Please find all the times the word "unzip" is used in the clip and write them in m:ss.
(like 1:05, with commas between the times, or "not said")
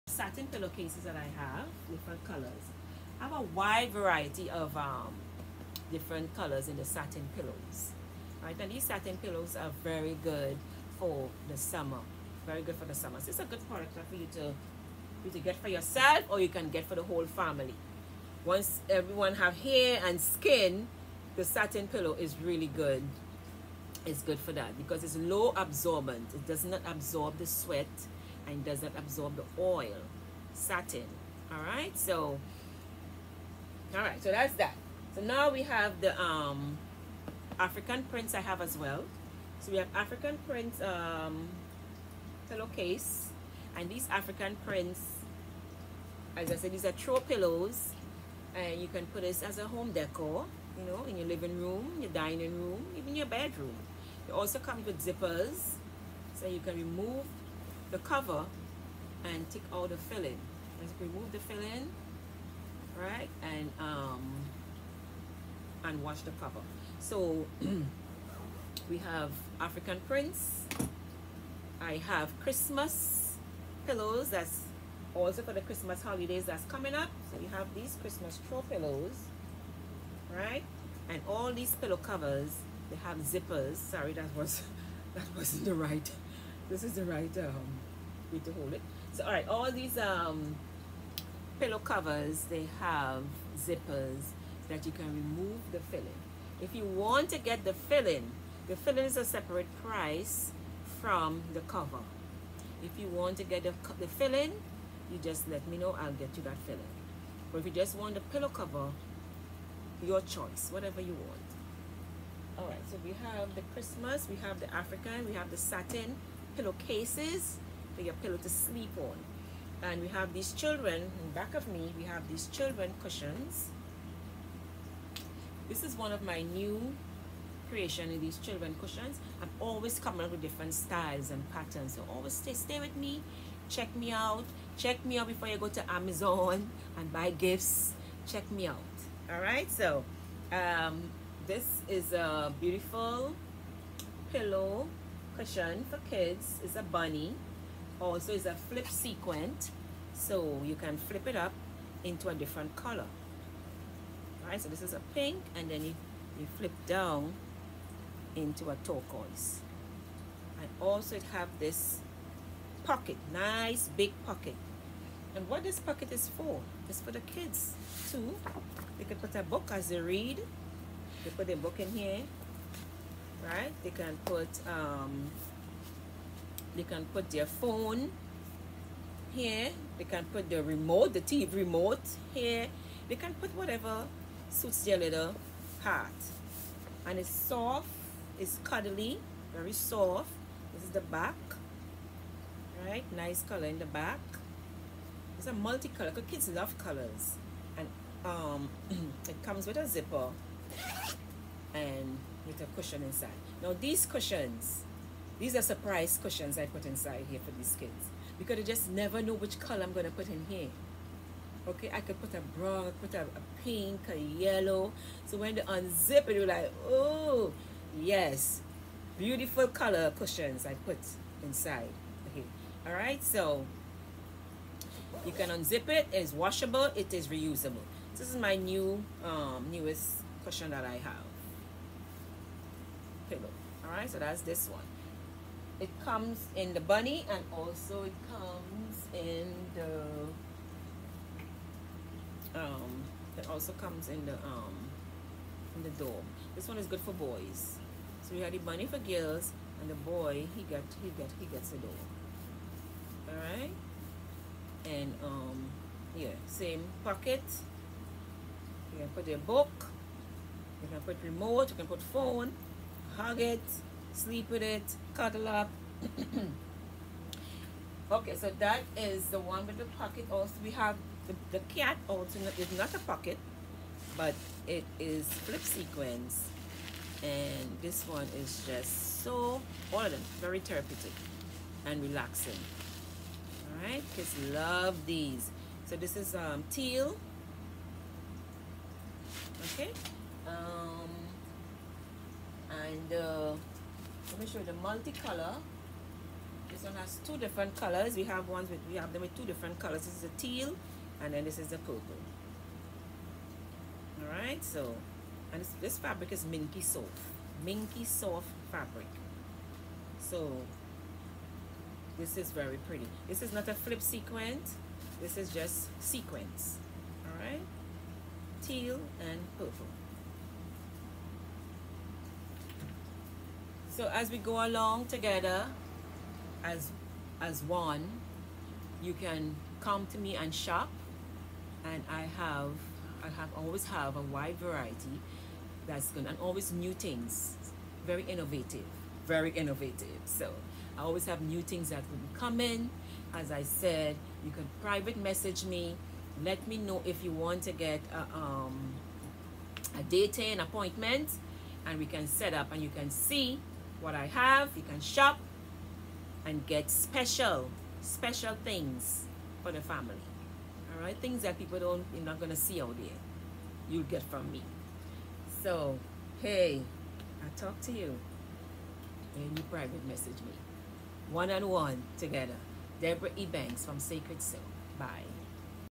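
3:35, 3:45.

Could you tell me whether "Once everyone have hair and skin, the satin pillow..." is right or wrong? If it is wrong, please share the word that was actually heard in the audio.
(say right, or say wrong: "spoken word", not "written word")
right.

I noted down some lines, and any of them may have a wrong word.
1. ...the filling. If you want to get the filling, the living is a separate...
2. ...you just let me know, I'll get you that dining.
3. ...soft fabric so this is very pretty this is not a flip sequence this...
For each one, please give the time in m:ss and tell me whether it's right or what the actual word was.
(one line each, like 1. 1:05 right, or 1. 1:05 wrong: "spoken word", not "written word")
1. 1:35 wrong: "filling", not "living"
2. 1:45 wrong: "filling", not "dining"
3. 5:08 right.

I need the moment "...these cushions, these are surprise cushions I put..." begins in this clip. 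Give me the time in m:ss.
3:23.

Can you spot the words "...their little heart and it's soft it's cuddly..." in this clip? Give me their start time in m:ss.
3:04.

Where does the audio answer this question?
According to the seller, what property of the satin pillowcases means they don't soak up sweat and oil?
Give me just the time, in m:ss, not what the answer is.
0:25.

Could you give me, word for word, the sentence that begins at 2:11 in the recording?
So always stay, stay with me, check me out.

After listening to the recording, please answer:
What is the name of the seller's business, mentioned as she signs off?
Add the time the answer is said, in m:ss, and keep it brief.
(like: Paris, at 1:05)
Sacred Sew, at 6:13.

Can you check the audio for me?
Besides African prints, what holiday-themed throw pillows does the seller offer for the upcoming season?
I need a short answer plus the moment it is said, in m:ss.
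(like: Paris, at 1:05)
Christmas pillows, at 1:12.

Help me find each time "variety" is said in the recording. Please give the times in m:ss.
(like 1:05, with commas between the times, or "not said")
0:03, 5:34.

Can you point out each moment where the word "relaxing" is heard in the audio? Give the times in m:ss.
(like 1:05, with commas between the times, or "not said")
4:42.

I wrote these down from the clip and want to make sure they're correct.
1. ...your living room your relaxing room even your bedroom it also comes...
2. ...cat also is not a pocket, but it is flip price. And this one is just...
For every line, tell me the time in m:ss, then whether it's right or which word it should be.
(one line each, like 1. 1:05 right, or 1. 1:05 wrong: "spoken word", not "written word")
1. 0:51 wrong: "dining", not "relaxing"
2. 4:31 wrong: "sequence", not "price".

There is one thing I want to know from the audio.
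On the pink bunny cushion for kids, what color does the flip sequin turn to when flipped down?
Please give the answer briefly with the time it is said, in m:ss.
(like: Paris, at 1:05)
Turquoise, at 2:38.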